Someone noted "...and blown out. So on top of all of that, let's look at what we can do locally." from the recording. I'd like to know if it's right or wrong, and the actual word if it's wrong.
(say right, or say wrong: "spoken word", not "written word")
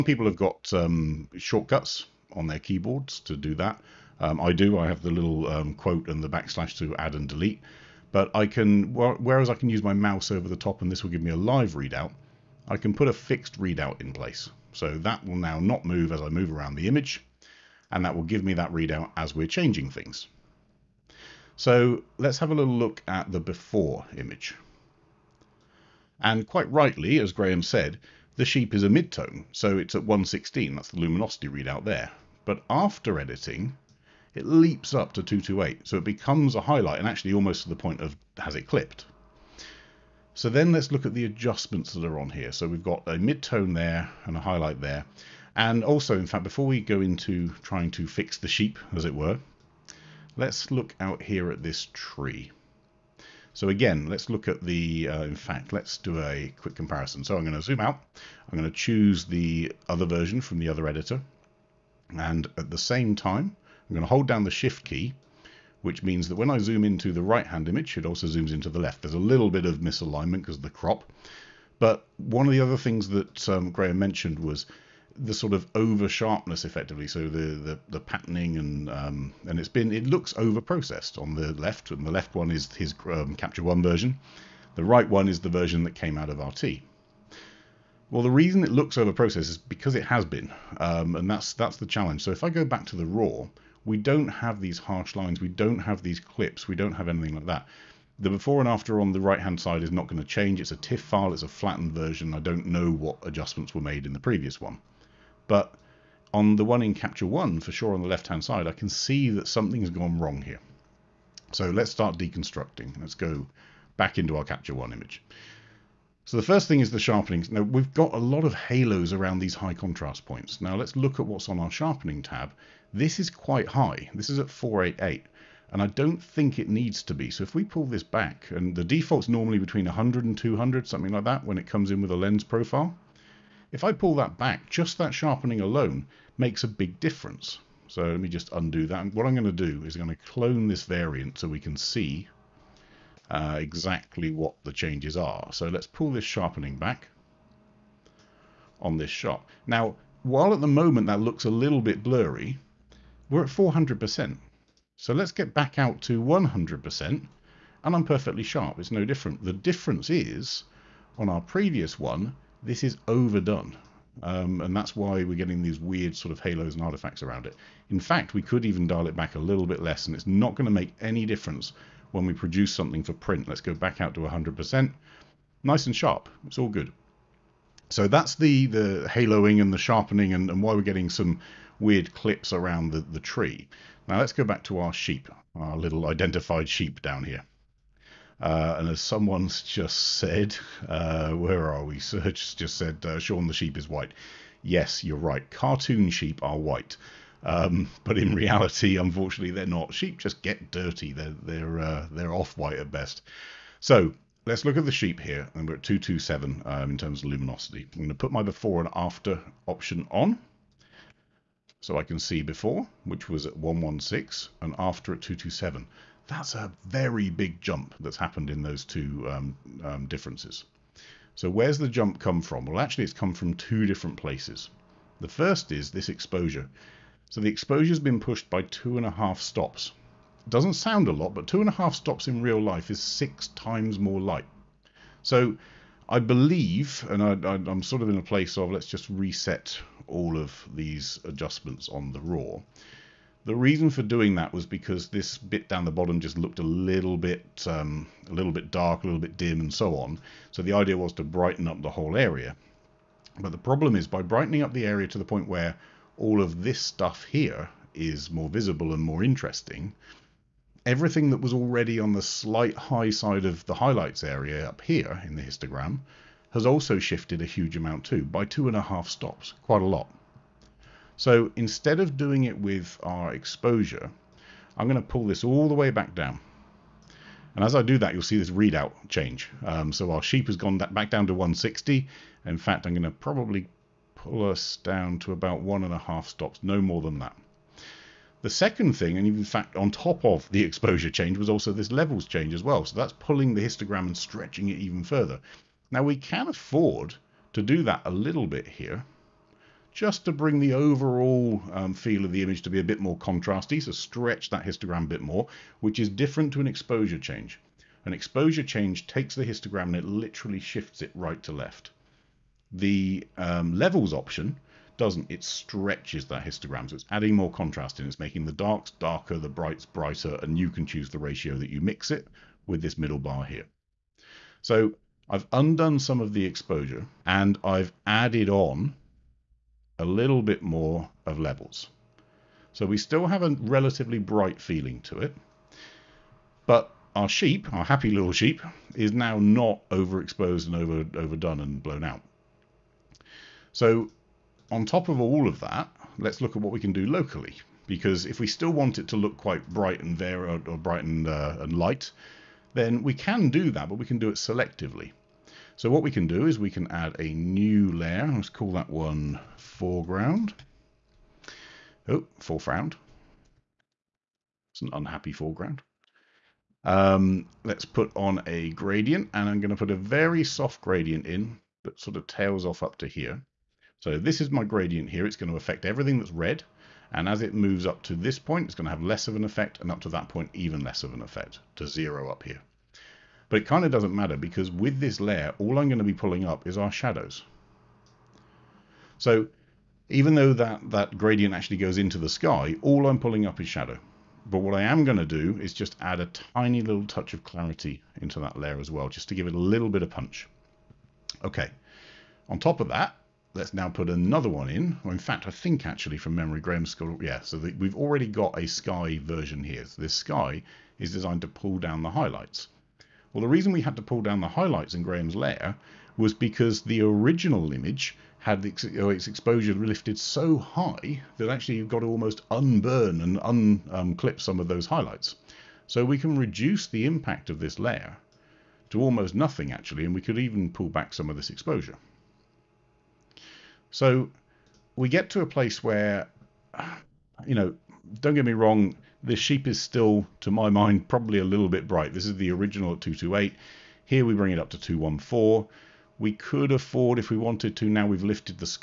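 right.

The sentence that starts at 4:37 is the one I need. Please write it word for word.
And as I do that, you'll see this readout change.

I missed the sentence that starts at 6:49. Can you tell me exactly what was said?
So this sky is designed to pull down the highlights.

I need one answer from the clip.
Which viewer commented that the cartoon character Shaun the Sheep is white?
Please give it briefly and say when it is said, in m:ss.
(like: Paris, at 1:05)
Serge, at 3:11.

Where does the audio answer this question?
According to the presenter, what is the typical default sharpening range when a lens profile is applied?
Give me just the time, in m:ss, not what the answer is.
2:09.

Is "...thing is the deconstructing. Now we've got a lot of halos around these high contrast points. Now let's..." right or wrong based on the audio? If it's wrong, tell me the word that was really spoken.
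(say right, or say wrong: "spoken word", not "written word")
wrong: "sharpening", not "deconstructing".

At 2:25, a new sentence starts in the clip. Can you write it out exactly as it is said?
So let's pull this sharpening back on this shot.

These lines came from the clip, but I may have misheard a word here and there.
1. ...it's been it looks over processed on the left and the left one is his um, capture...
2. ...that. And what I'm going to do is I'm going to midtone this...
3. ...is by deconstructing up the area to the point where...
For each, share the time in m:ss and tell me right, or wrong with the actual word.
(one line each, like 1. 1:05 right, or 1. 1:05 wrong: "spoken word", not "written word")
1. 1:19 right
2. 2:18 wrong: "clone", not "midtone"
3. 4:13 wrong: "brightening", not "deconstructing".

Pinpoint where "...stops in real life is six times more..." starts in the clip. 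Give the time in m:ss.
3:51.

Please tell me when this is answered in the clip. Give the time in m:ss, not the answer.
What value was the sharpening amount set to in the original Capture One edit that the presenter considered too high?
2:04.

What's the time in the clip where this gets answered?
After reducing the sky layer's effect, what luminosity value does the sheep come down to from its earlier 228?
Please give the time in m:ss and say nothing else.
7:24.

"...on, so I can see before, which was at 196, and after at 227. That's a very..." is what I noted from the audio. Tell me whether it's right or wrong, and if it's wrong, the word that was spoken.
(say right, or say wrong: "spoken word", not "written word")
wrong: "116", not "196".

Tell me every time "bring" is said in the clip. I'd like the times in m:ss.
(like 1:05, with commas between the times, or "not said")
5:00, 7:24.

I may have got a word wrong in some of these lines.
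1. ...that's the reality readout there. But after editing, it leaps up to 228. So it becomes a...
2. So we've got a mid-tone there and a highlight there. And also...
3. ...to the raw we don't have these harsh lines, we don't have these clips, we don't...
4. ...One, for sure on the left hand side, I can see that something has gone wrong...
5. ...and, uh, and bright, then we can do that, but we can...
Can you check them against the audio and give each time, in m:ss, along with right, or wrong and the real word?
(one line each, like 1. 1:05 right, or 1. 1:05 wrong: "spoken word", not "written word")
1. 0:30 wrong: "luminosity", not "reality"
2. 0:42 right
3. 1:32 right
4. 1:47 right
5. 5:51 wrong: "light", not "bright".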